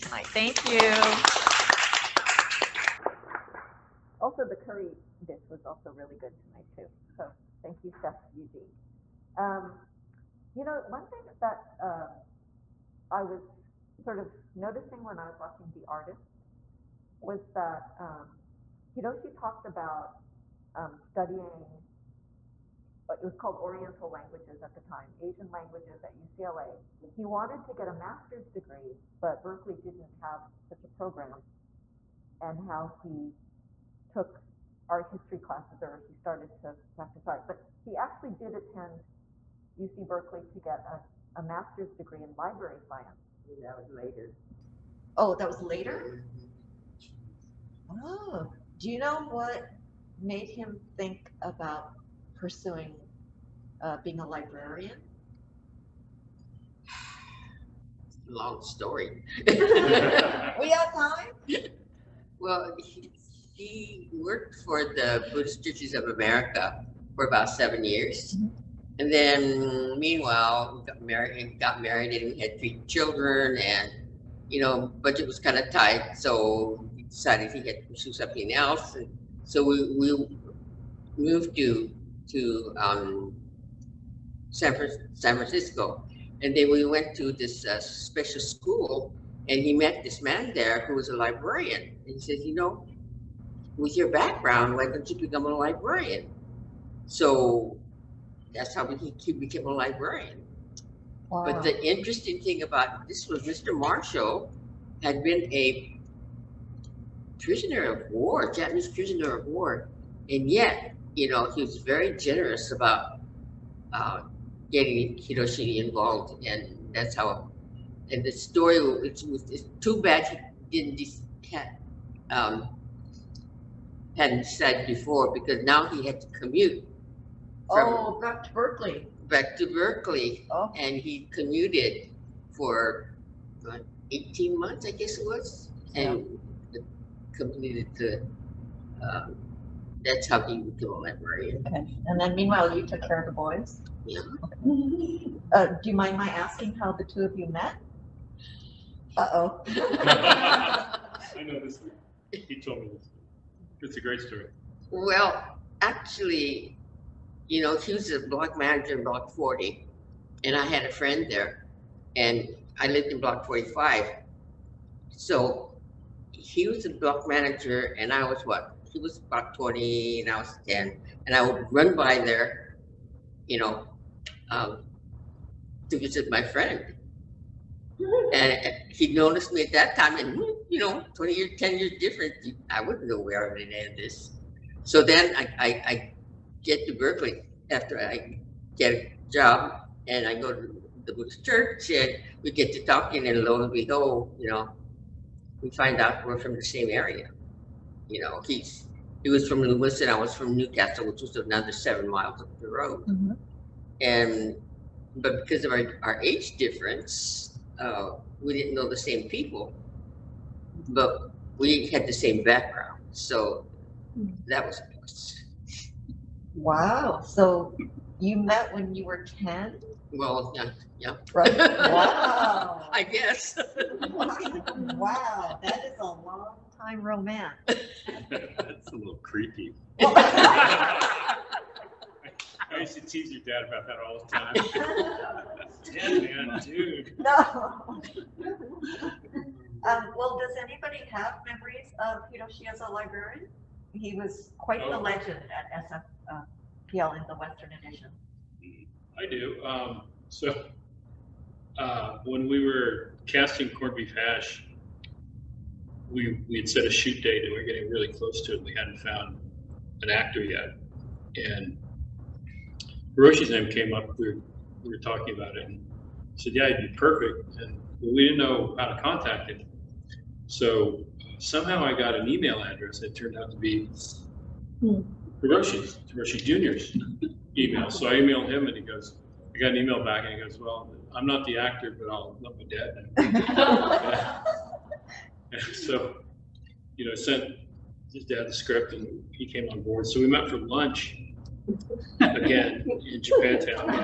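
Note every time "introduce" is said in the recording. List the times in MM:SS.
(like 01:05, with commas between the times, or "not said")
not said.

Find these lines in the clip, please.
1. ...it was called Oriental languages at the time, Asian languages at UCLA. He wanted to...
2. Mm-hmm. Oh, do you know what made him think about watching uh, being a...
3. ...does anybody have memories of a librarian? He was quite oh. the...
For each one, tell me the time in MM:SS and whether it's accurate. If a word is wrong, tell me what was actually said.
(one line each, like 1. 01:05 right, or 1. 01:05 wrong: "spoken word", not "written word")
1. 00:23 right
2. 00:47 wrong: "pursuing", not "watching"
3. 04:00 right.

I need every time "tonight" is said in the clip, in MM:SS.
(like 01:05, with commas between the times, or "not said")
00:00, 00:06.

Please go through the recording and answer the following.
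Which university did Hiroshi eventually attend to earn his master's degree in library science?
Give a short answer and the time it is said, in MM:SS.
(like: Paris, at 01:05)
UC Berkeley, at 00:39.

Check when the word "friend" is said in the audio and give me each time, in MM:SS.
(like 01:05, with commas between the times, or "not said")
02:40, 02:56.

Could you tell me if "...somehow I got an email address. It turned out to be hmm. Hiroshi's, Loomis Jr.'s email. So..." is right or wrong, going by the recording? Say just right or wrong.
wrong.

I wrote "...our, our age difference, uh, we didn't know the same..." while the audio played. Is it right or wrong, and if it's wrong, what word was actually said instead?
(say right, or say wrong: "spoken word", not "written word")
right.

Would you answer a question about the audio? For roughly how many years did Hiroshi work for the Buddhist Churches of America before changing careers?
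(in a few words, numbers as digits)
7.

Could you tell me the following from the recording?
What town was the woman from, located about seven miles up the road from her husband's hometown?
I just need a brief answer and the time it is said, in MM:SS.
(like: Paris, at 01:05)
Newcastle, at 03:20.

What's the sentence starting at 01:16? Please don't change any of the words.
So he decided he had to pursue something else.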